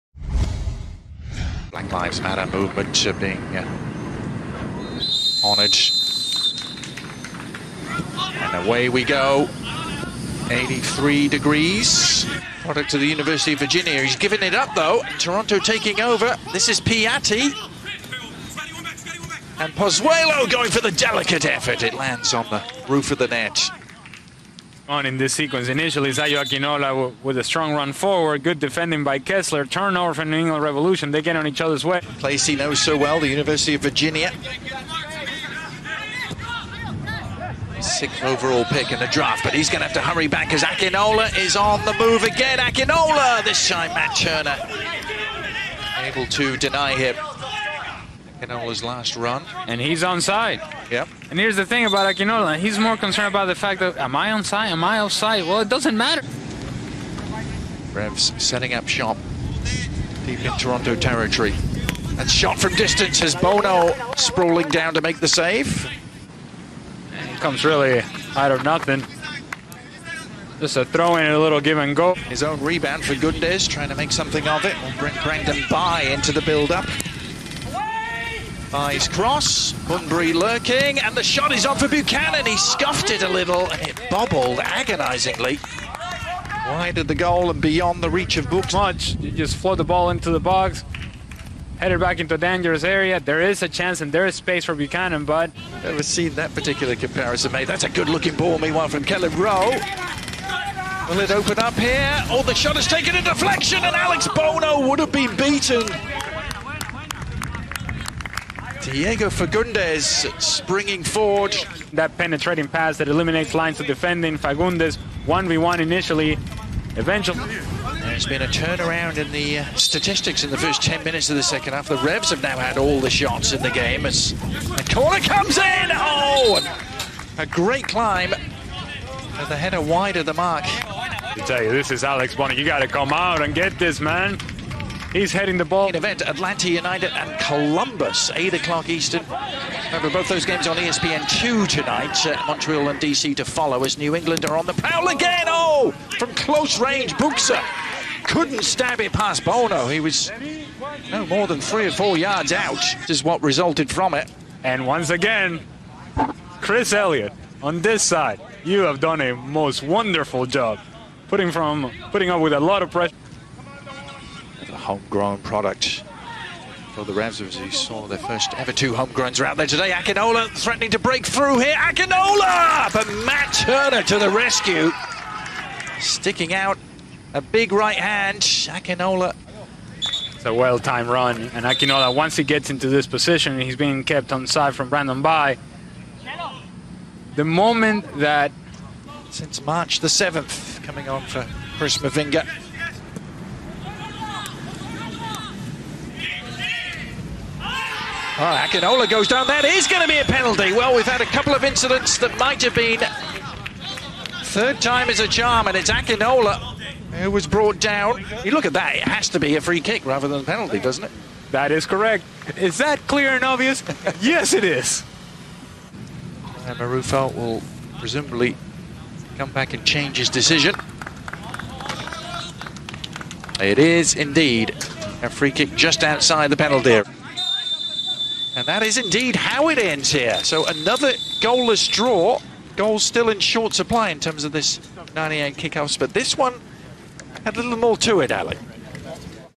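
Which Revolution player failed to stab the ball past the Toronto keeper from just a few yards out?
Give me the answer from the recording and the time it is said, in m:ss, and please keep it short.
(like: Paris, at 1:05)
Buksa, at 2:27.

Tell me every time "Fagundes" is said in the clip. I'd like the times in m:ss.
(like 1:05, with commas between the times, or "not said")
1:49, 1:54.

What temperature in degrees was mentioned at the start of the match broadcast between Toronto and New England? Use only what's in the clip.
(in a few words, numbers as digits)
83.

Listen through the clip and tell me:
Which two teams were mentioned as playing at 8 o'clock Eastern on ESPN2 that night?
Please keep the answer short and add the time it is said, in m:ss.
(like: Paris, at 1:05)
Atlanta United and Columbus, at 2:16.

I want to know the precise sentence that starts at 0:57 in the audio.
Revs setting up shop deep in Toronto territory.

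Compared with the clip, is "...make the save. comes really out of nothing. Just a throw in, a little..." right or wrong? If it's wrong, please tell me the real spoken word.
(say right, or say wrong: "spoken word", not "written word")
right.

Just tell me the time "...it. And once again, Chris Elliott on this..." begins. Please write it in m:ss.
2:34.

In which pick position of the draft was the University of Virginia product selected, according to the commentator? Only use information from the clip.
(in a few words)
Sixth.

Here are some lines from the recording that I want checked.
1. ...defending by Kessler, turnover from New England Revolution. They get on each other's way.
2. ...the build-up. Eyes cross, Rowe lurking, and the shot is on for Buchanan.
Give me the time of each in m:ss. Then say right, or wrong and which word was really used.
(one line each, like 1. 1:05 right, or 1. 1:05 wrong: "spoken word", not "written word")
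1. 0:28 right
2. 1:16 wrong: "Bunbury", not "Rowe".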